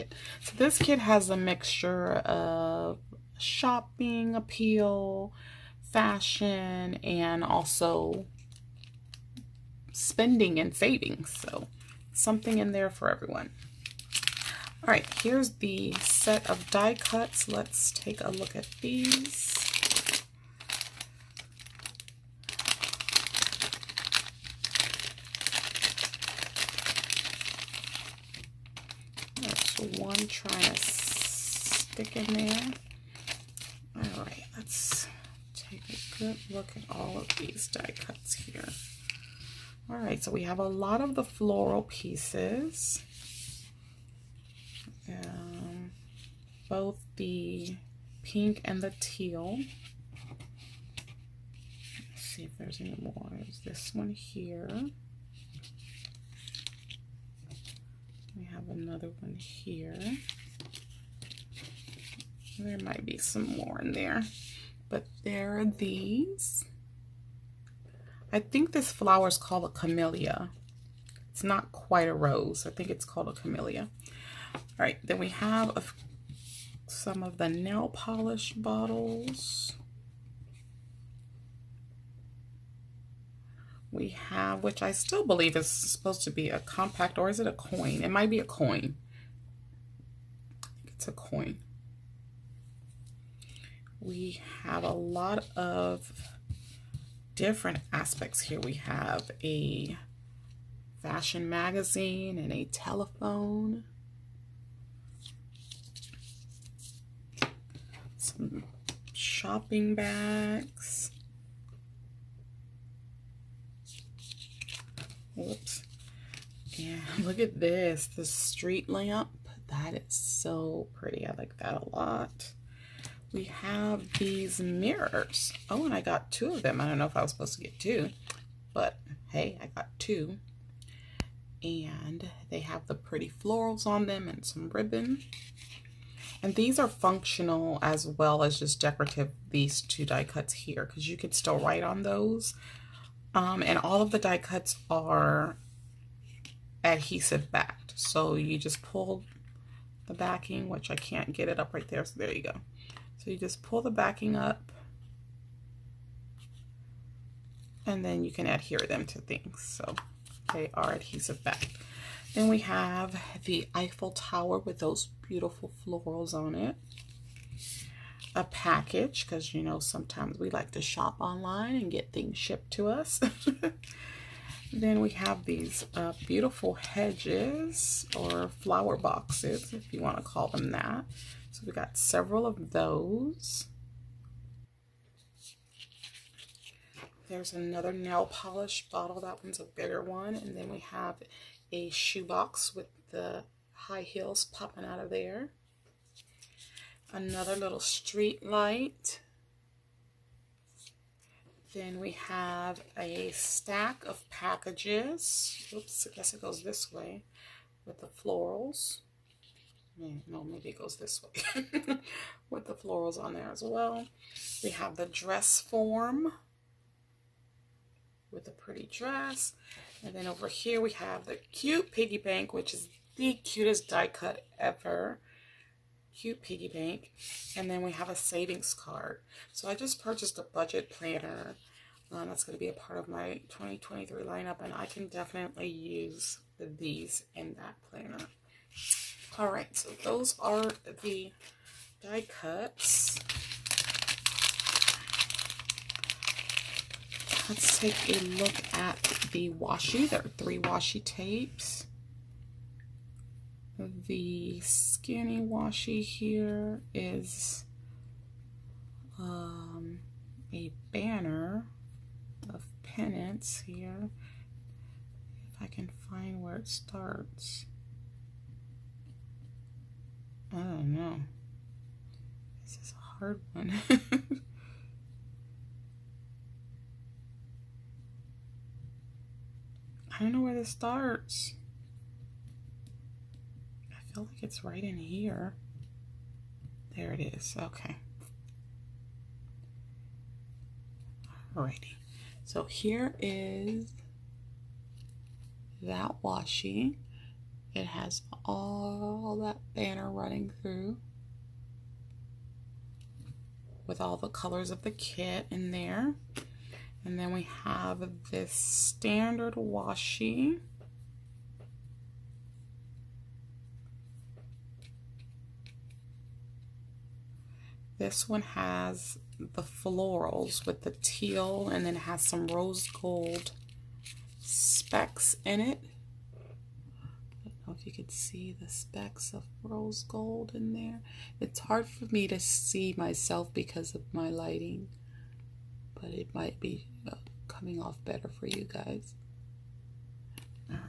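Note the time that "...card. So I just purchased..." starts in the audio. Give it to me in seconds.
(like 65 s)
228 s.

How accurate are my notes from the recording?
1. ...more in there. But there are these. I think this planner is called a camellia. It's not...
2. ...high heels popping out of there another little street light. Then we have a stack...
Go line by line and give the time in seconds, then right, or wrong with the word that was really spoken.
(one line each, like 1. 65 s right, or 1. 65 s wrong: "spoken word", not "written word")
1. 63 s wrong: "flower", not "planner"
2. 193 s right.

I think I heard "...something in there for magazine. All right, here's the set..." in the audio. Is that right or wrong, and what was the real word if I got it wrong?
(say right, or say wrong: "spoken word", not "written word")
wrong: "everyone", not "magazine".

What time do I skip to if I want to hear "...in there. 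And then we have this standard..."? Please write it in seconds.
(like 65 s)
305 s.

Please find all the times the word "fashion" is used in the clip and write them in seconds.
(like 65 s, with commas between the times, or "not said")
5 s, 101 s.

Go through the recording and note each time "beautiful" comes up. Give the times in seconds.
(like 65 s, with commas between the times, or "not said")
165 s, 176 s.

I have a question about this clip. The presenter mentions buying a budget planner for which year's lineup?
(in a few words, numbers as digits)
2023.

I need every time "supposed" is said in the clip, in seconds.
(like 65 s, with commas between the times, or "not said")
85 s, 127 s.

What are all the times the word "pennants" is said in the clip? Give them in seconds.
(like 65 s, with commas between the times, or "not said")
262 s.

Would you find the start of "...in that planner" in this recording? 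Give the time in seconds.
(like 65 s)
237 s.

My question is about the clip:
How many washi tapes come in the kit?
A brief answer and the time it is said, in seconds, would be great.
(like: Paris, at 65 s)
3, at 250 s.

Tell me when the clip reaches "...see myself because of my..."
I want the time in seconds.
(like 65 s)
332 s.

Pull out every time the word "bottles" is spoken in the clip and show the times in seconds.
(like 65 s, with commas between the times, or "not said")
78 s, 188 s.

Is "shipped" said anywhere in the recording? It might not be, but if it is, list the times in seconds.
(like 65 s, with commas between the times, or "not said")
172 s.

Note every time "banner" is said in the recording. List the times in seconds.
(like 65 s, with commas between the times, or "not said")
260 s, 299 s.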